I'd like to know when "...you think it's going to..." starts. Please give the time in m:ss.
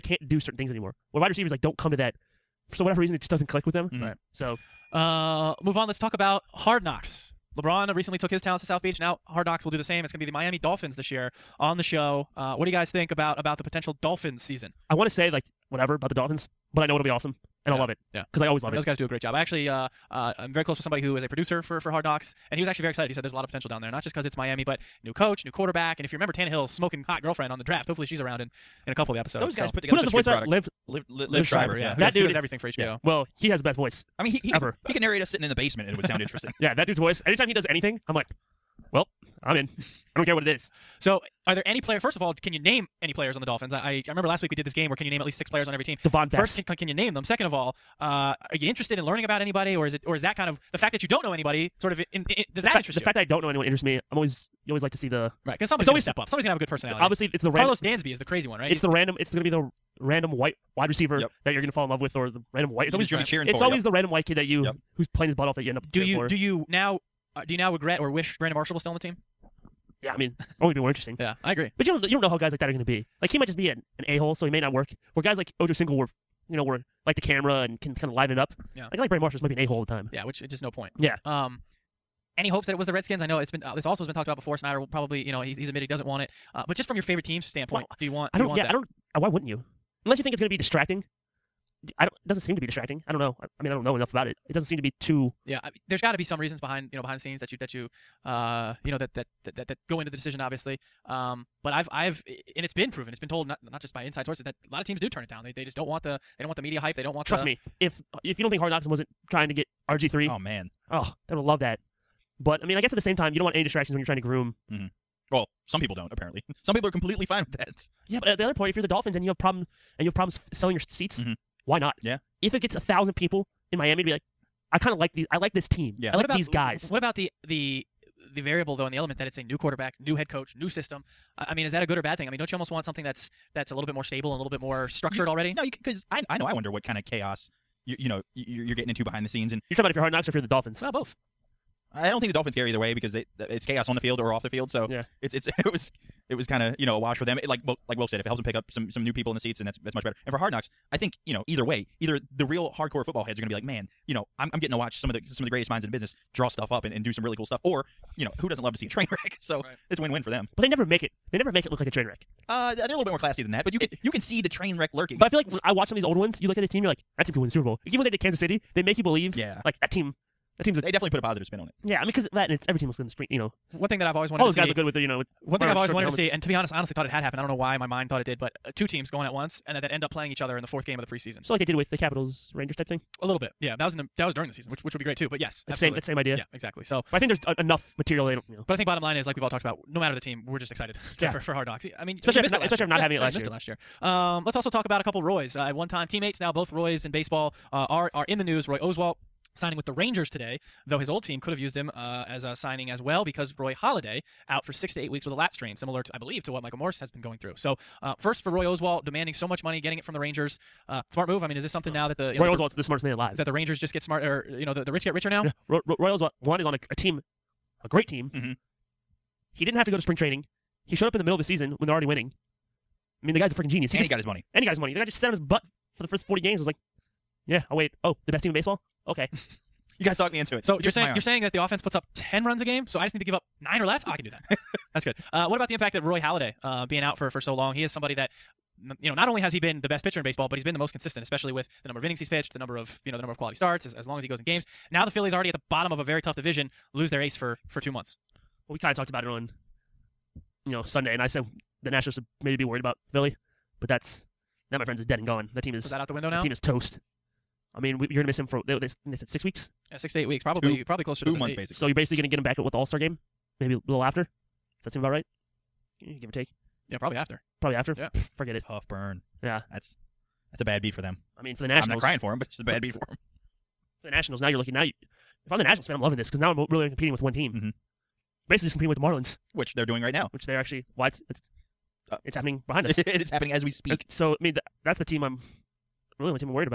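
1:30.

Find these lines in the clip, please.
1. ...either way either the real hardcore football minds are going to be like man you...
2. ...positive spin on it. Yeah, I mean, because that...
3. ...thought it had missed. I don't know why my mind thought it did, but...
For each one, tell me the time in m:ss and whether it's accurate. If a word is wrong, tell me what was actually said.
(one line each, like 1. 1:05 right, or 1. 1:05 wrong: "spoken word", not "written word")
1. 2:31 wrong: "heads", not "minds"
2. 2:51 right
3. 2:56 wrong: "happened", not "missed".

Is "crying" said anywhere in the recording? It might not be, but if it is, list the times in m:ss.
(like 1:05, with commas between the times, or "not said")
4:32.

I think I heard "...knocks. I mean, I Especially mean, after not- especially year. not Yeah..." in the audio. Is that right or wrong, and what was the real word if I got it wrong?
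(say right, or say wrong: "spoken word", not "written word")
right.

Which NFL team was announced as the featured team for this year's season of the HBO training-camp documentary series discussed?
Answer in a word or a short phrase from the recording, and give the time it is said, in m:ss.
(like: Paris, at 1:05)
Miami Dolphins, at 0:10.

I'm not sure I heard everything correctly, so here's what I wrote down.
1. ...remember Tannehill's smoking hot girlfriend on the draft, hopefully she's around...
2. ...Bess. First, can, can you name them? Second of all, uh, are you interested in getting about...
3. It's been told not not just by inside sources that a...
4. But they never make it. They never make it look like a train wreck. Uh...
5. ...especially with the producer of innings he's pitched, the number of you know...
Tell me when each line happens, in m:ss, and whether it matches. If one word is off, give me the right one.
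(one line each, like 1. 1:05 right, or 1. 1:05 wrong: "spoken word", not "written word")
1. 0:26 right
2. 0:46 wrong: "learning", not "getting"
3. 1:43 right
4. 2:40 right
5. 4:01 wrong: "number", not "producer".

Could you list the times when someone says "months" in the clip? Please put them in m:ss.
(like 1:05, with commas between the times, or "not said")
4:07, 4:21.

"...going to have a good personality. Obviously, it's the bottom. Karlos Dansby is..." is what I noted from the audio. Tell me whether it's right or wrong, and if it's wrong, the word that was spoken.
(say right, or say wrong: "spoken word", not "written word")
wrong: "random", not "bottom".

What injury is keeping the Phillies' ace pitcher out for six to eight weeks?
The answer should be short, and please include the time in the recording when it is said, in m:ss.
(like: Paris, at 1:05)
lat strain, at 3:25.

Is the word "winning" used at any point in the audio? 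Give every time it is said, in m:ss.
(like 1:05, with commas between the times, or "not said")
3:42.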